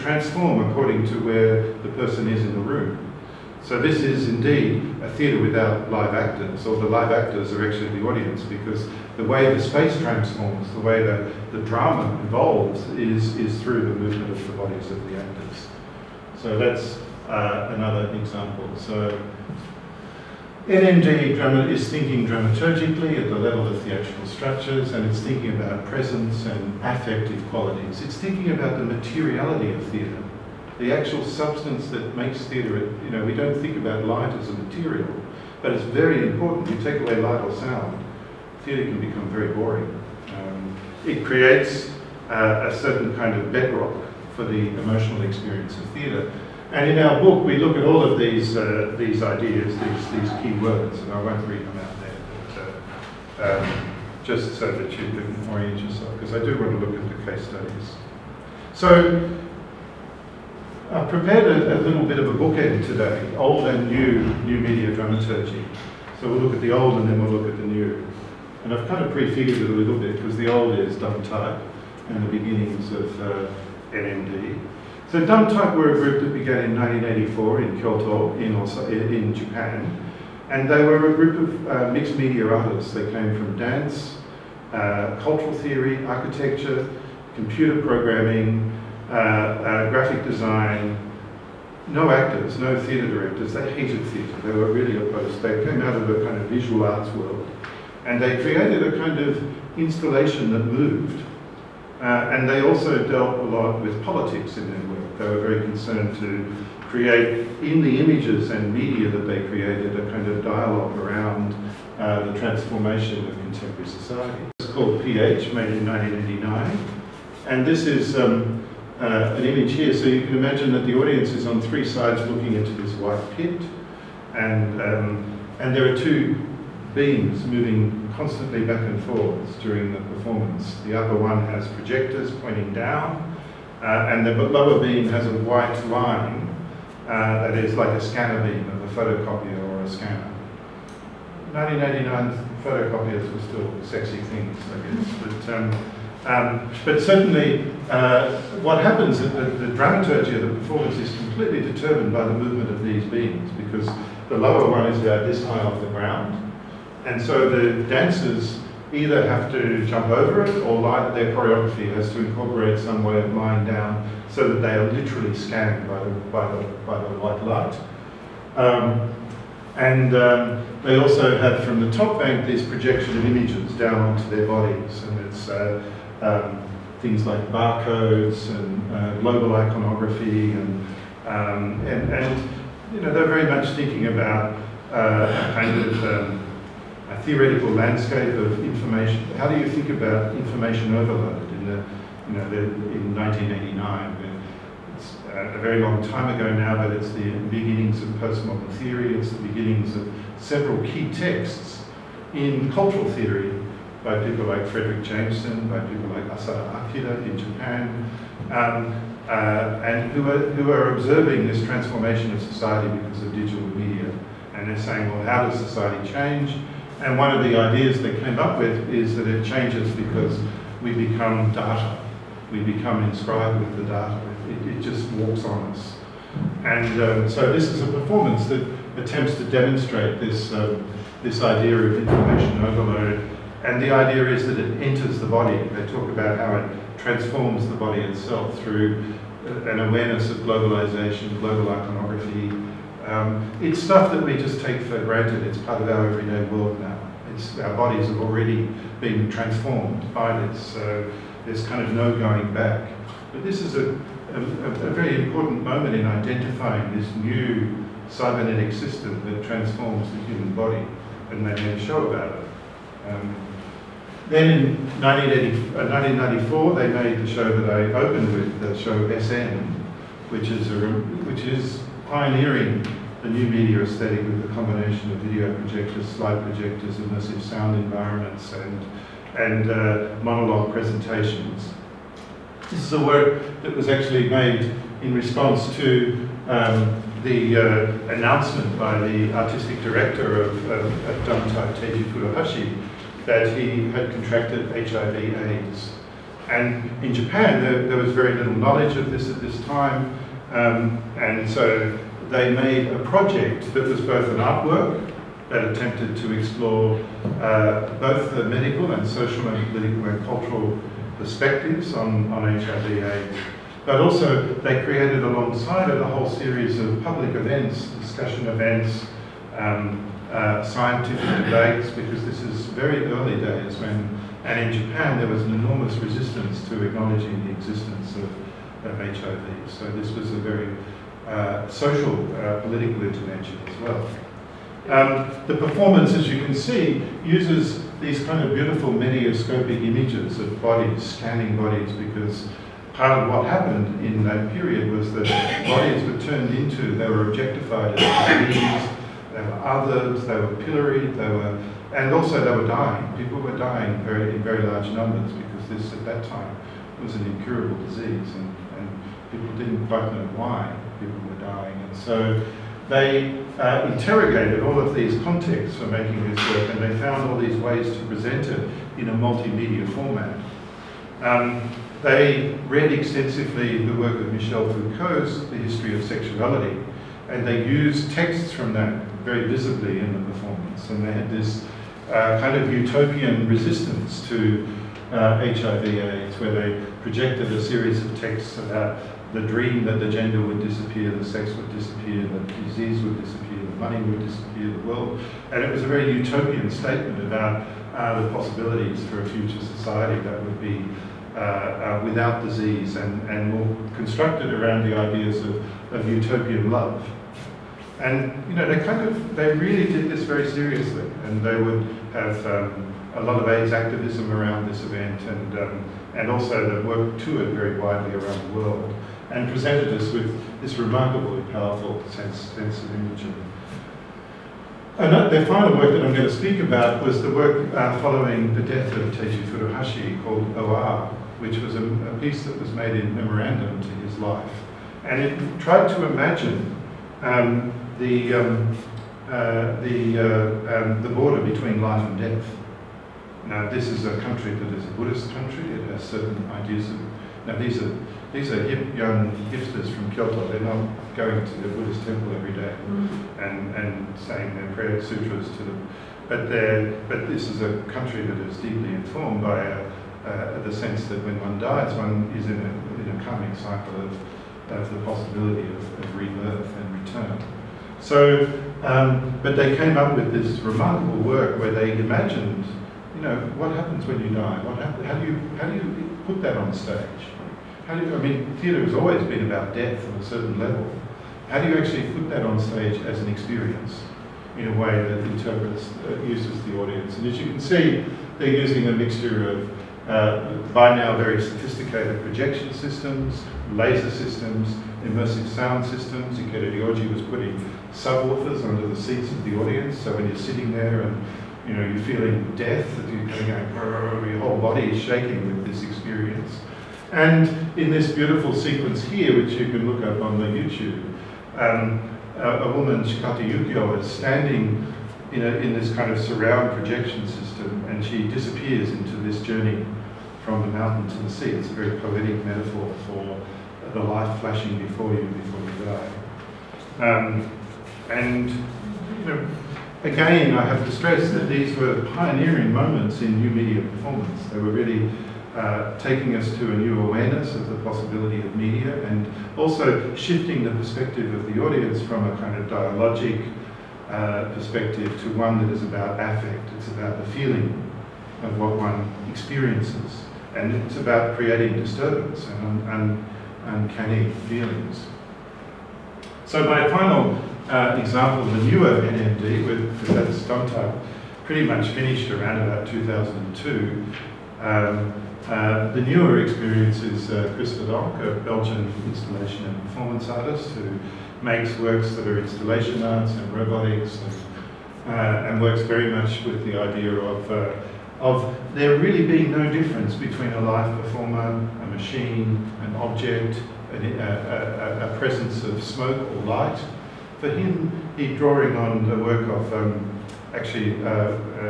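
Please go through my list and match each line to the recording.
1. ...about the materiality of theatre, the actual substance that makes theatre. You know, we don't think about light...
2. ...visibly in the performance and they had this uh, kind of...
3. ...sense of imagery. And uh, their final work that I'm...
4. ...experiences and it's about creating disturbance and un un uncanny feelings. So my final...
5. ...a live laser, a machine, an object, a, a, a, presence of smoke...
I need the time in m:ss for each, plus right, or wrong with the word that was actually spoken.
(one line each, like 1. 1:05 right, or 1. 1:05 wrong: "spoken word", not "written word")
1. 0:28 right
2. 6:19 right
3. 7:02 right
4. 9:09 right
5. 9:40 wrong: "performer", not "laser".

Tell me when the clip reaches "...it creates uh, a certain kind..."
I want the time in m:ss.
0:41.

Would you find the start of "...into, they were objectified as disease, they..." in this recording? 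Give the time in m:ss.
5:46.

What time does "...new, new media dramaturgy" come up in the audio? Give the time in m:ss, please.
1:03.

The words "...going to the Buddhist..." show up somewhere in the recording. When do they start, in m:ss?
7:31.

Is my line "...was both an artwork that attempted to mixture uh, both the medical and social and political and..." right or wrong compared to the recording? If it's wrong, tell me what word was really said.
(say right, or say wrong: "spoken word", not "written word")
wrong: "explore", not "mixture".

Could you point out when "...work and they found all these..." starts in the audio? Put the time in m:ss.
6:06.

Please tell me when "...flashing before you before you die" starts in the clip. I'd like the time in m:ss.
8:44.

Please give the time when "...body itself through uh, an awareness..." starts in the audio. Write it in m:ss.
3:57.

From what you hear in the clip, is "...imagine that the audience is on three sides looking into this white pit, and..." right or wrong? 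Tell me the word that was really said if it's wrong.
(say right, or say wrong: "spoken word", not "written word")
right.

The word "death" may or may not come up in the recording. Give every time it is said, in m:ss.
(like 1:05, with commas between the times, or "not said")
7:08, 7:22, 7:59, 8:22.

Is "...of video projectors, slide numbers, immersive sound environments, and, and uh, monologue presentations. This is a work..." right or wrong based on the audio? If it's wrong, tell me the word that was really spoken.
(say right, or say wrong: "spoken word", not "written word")
wrong: "projectors", not "numbers".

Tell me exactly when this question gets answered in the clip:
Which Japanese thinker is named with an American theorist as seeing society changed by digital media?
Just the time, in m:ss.
3:26.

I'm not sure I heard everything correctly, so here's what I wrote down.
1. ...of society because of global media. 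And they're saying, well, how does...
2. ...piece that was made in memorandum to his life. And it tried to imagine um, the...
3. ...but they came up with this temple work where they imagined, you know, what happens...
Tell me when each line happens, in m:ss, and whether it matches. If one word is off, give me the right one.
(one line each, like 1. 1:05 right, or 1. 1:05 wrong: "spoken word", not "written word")
1. 3:32 wrong: "digital", not "global"
2. 7:12 right
3. 7:49 wrong: "remarkable", not "temple".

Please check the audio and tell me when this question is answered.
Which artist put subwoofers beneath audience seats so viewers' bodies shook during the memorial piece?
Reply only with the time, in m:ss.
8:16.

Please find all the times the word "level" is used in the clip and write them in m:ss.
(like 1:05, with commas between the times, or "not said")
0:23, 8:00.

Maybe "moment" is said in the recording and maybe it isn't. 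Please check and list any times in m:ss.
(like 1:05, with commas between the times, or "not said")
4:15, 8:52.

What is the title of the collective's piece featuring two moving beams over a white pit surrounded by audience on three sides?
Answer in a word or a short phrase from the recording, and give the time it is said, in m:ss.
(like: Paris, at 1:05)
PH, at 1:55.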